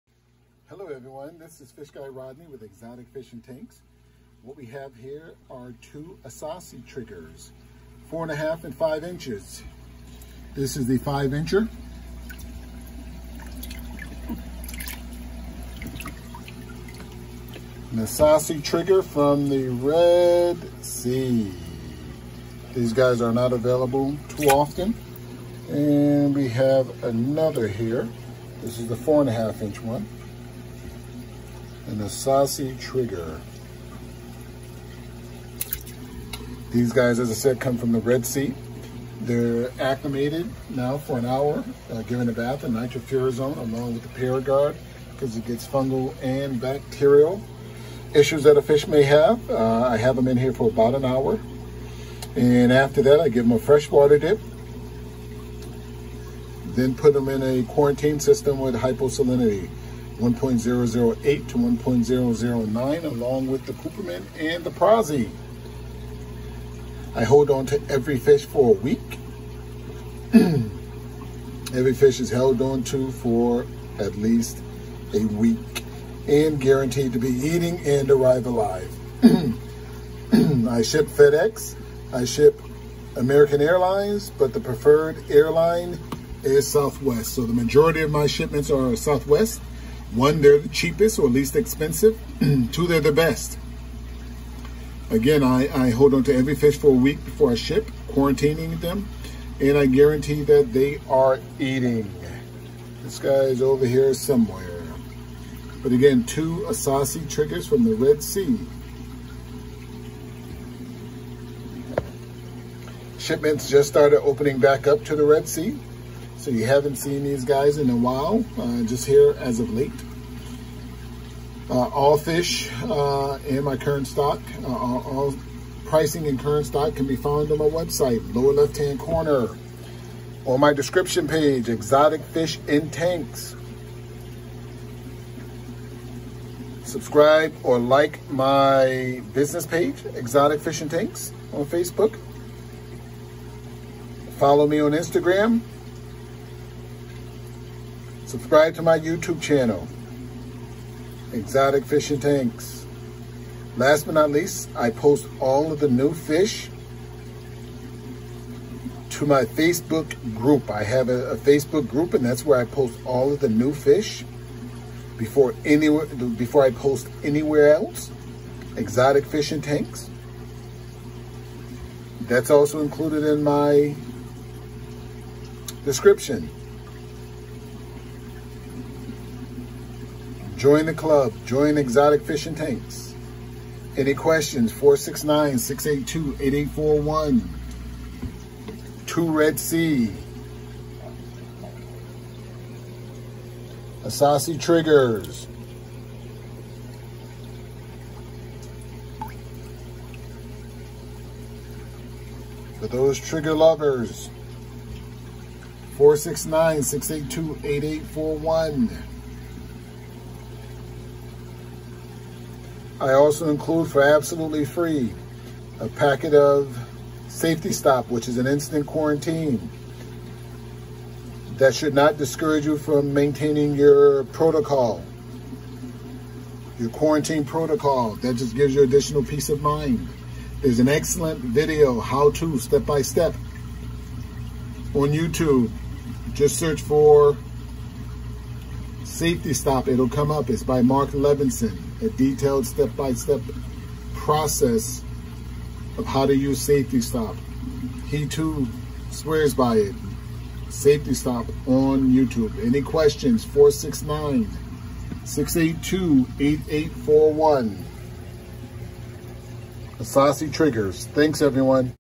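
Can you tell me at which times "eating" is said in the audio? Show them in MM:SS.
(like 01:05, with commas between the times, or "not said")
01:17, 01:41.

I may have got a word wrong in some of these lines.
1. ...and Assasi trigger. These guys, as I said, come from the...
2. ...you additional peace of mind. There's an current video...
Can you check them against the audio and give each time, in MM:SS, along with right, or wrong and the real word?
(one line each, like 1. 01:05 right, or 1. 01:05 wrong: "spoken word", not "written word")
1. 00:31 right
2. 03:48 wrong: "excellent", not "current".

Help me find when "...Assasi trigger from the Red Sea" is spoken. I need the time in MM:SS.
00:17.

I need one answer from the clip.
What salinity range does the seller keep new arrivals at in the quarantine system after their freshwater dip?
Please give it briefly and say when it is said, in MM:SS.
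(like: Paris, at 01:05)
1.008 to 1.009, at 01:00.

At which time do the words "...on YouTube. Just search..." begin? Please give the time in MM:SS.
03:54.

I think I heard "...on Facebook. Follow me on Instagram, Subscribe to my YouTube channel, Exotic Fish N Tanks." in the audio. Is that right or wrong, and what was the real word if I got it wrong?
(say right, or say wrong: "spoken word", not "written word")
right.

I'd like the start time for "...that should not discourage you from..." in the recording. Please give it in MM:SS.
03:41.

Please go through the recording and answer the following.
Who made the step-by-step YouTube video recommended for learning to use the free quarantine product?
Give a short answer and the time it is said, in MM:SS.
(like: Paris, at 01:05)
Mark Levinson, at 04:00.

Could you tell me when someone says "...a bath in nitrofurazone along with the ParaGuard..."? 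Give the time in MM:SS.
00:42.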